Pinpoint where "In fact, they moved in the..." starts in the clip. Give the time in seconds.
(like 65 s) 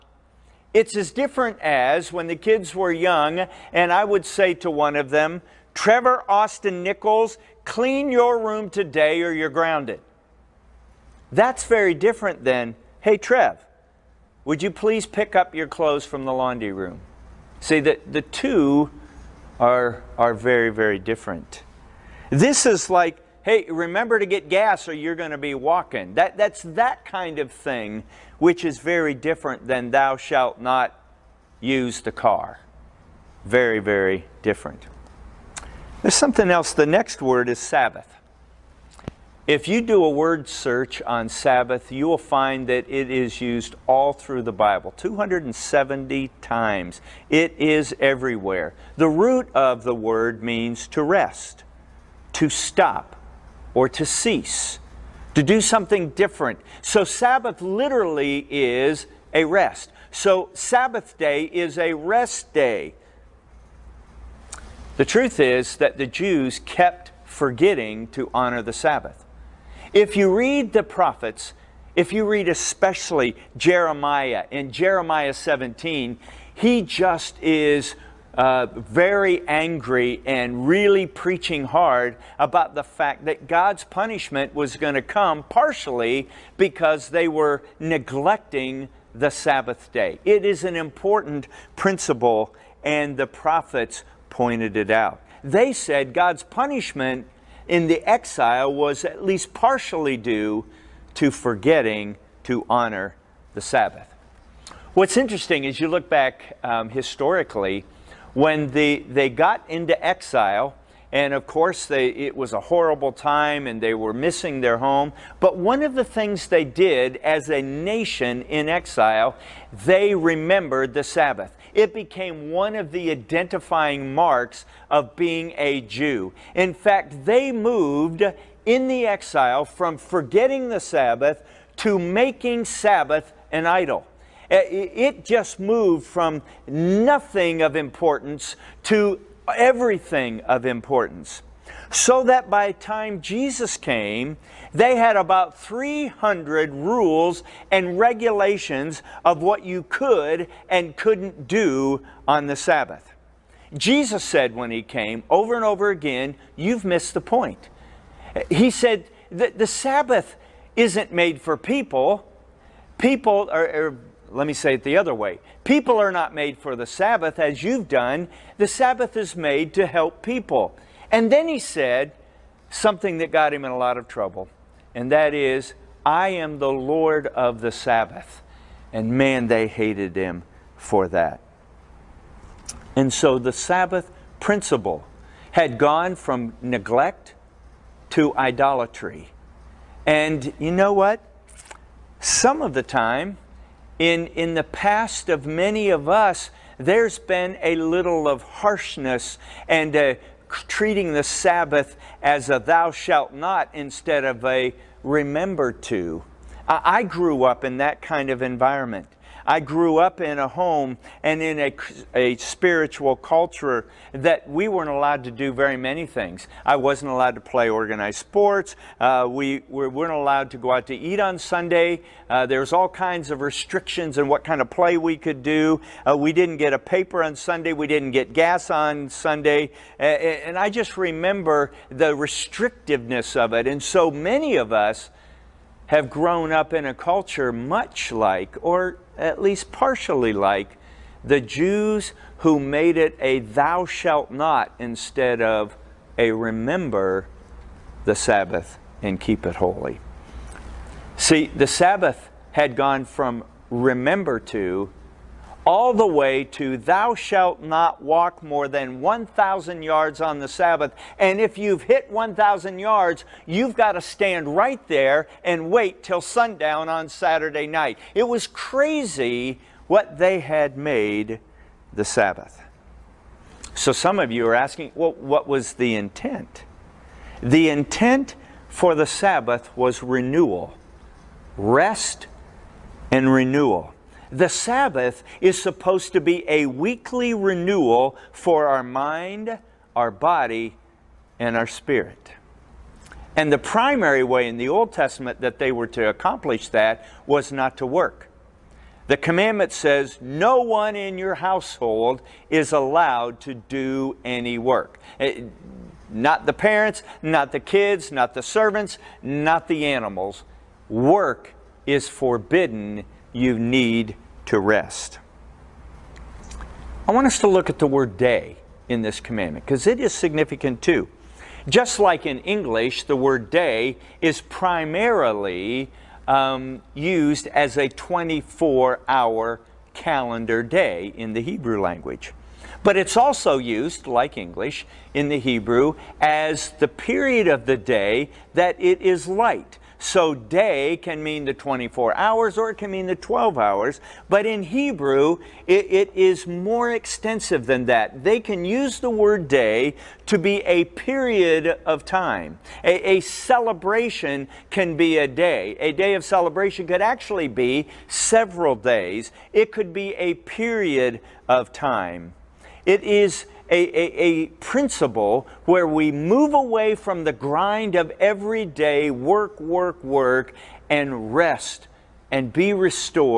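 126 s.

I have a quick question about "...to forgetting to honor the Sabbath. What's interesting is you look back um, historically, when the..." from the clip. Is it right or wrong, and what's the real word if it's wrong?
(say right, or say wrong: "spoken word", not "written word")
right.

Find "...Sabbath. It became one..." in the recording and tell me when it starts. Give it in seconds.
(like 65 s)
121 s.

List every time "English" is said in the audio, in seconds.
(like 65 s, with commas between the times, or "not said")
322 s, 334 s.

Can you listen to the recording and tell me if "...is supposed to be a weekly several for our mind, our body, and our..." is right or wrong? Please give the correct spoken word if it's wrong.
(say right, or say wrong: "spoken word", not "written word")
wrong: "renewal", not "several".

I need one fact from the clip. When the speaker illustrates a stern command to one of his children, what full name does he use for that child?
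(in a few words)
Trevor Austin Nichols.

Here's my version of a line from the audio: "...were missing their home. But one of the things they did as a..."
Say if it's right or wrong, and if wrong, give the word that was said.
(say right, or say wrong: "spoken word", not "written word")
right.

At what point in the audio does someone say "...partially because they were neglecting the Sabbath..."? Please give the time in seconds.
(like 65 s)
85 s.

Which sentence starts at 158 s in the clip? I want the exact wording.
He said that the Sabbath isn't made for people.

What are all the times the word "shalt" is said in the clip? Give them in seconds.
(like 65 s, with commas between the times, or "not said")
30 s, 202 s, 243 s, 257 s.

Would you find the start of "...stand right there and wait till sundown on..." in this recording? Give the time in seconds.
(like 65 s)
264 s.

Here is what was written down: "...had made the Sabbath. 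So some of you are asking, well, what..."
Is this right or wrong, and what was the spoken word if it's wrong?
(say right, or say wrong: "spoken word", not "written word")
right.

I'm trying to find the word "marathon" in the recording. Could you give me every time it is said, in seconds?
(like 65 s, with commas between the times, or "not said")
not said.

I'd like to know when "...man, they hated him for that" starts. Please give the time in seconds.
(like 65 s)
179 s.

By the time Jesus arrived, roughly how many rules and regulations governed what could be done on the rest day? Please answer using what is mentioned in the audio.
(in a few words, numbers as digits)
300.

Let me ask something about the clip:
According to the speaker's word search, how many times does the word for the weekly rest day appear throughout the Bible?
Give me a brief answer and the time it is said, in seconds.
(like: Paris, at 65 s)
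270, at 44 s.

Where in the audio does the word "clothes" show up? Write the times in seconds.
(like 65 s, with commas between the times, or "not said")
15 s.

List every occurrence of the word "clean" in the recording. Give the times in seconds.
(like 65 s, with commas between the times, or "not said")
7 s.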